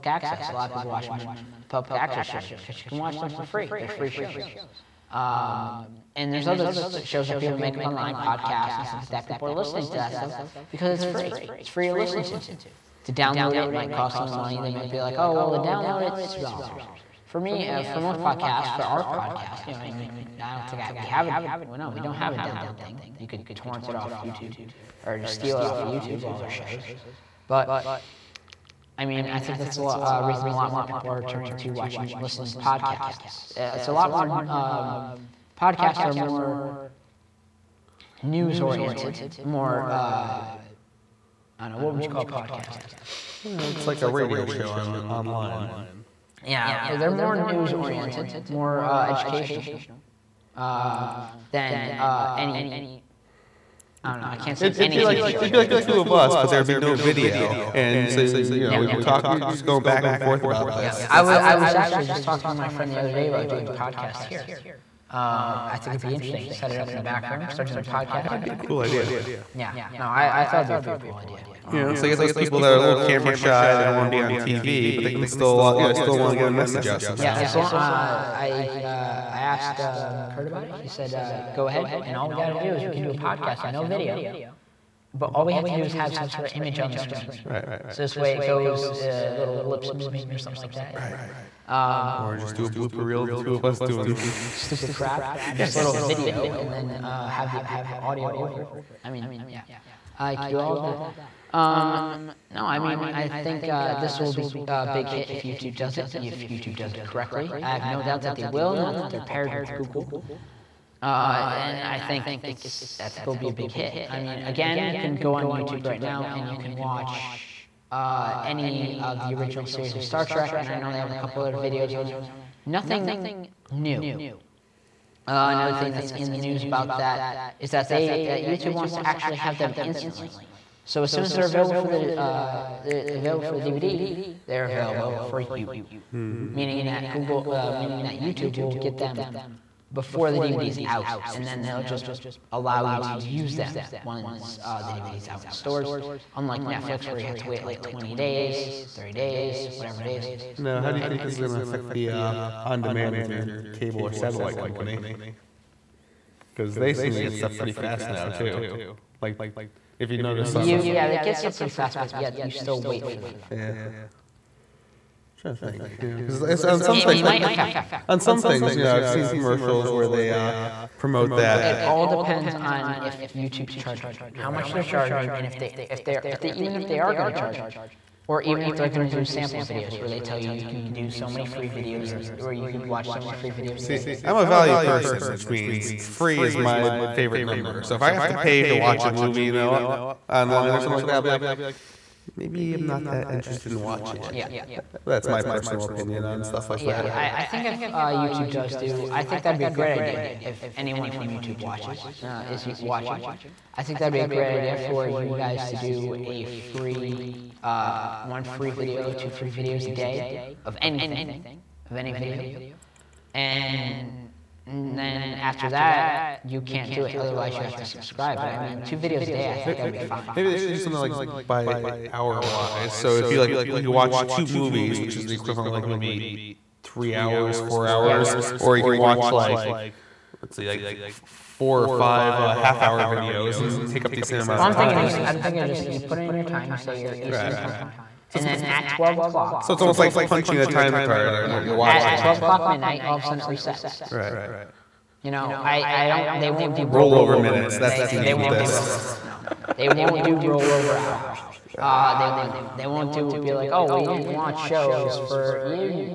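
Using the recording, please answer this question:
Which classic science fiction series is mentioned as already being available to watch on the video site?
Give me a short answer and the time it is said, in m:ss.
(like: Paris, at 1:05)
Star Trek, at 2:00.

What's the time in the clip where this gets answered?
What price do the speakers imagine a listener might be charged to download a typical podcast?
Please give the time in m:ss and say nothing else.
0:16.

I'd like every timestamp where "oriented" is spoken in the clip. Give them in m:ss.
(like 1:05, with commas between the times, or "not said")
0:38, 0:47.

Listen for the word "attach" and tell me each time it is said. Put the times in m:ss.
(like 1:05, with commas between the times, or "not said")
not said.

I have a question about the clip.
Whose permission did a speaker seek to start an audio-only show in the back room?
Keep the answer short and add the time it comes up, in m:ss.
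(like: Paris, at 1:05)
Kurt, at 1:20.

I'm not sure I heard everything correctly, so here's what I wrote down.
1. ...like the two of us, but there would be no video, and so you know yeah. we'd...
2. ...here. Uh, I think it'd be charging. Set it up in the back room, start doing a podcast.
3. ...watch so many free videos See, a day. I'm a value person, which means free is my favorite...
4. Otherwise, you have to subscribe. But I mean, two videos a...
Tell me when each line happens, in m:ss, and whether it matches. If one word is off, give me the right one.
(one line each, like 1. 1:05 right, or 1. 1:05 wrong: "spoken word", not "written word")
1. 0:55 right
2. 1:04 wrong: "interesting", not "charging"
3. 3:02 right
4. 3:37 right.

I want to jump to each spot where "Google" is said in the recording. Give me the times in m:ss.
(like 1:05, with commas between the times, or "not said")
1:49, 2:17.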